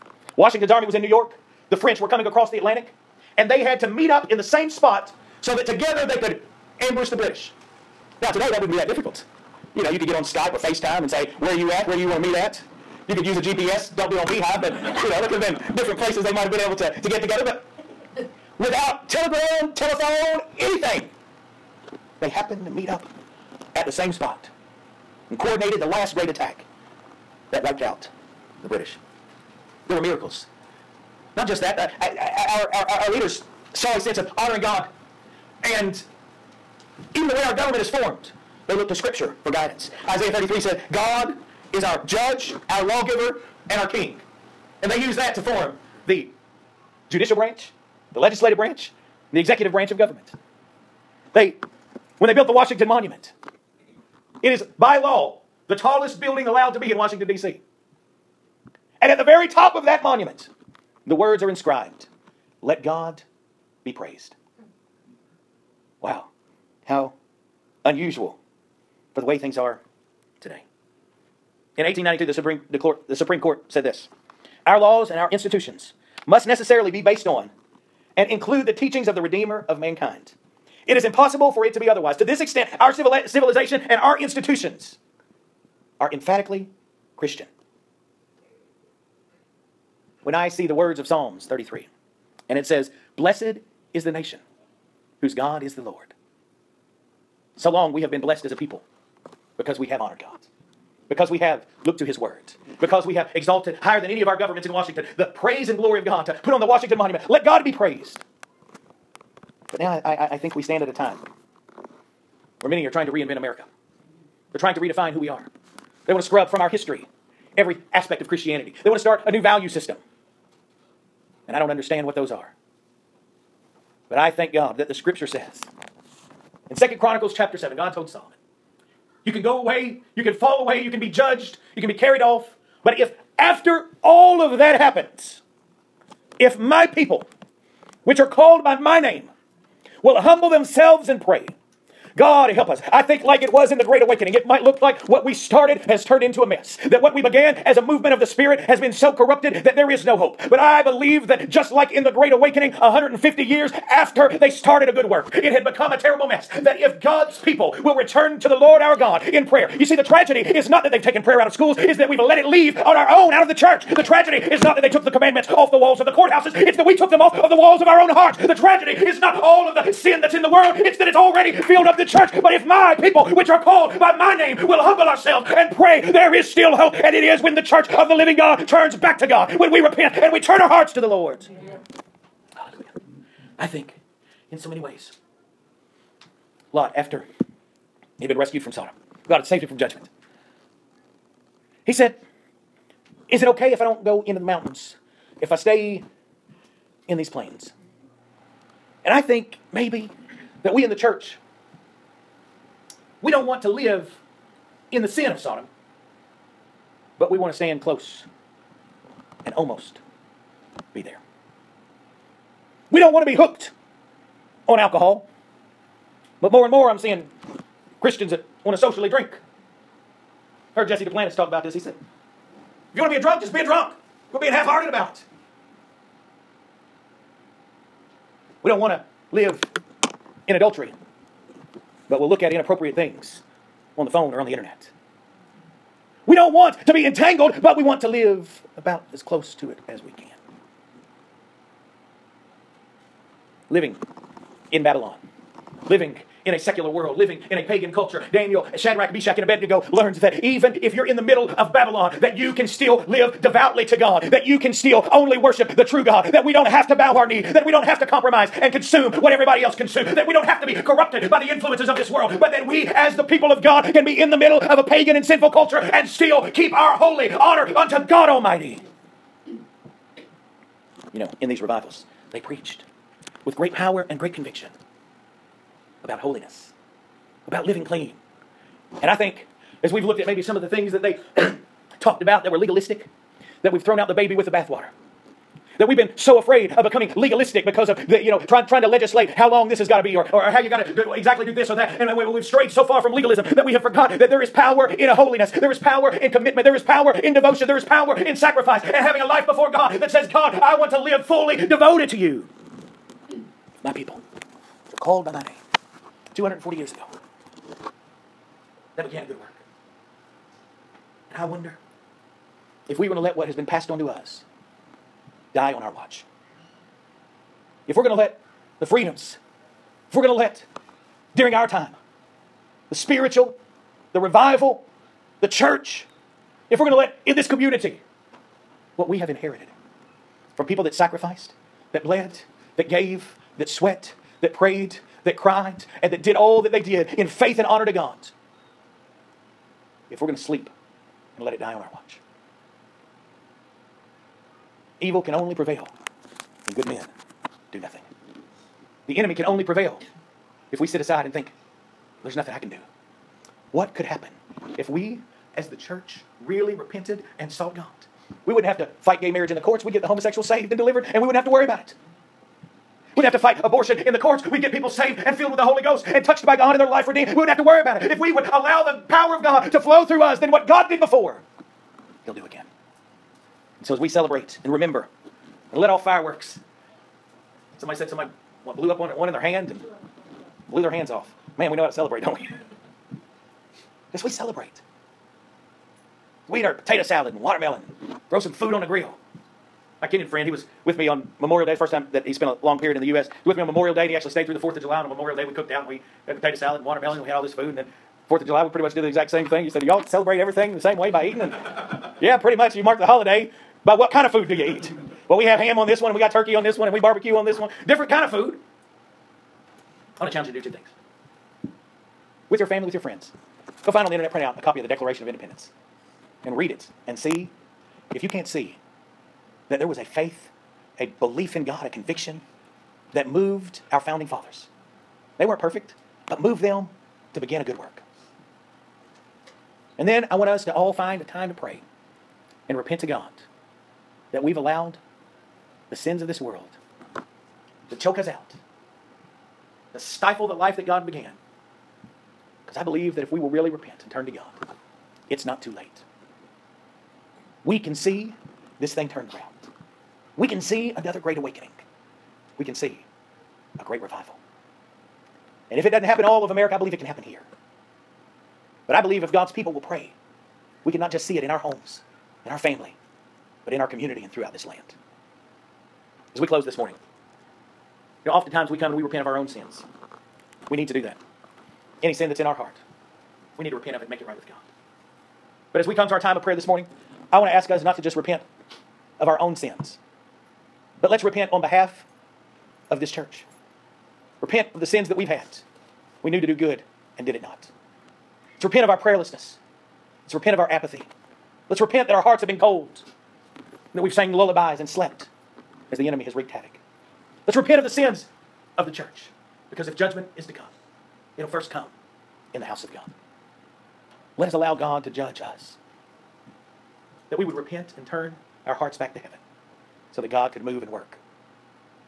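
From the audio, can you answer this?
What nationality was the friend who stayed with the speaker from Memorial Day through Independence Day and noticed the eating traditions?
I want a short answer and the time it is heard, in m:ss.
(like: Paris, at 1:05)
Kenyan, at 6:30.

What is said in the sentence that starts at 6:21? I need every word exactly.
Man, we know how to celebrate, don't we?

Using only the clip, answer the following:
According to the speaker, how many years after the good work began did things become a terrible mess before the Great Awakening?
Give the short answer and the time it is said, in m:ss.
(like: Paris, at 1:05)
150 years, at 2:32.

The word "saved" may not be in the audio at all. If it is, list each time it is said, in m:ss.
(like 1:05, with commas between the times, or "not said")
3:09, 6:00, 6:04.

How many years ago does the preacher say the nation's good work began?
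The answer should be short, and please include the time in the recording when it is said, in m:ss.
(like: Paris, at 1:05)
240 years, at 5:06.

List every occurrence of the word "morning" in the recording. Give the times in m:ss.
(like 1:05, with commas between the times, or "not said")
7:46, 7:56.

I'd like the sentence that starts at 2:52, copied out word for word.
But if my people, which are called by my name, will humble ourselves, and pray.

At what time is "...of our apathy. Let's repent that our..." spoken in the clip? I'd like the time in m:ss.
8:10.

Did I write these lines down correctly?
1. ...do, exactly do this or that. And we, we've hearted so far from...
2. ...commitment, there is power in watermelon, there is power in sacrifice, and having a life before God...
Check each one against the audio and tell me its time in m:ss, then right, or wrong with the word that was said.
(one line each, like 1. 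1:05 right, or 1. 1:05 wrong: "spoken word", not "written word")
1. 4:50 wrong: "strayed", not "hearted"
2. 4:56 wrong: "devotion", not "watermelon".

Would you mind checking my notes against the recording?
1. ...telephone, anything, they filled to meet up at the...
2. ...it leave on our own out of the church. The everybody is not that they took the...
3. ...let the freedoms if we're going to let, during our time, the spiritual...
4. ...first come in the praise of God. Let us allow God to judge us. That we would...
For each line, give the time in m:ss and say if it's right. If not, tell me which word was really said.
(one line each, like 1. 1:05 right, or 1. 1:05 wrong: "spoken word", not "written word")
1. 0:19 wrong: "happened", not "filled"
2. 2:42 wrong: "tragedy", not "everybody"
3. 5:18 right
4. 8:21 wrong: "house", not "praise".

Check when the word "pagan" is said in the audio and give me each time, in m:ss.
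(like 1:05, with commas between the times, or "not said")
4:07, 4:24.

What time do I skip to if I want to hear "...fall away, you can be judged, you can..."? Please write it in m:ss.
2:10.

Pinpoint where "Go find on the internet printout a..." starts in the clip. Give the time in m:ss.
6:53.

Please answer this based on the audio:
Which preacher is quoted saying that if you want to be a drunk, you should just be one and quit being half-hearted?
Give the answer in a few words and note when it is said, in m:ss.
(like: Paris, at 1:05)
Jesse Duplantis, at 3:40.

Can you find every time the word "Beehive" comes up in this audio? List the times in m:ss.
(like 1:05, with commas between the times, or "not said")
0:14.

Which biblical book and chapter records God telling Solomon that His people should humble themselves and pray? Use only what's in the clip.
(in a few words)
Second Chronicles 7.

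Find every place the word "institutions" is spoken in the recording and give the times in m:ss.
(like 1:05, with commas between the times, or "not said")
1:15, 1:24.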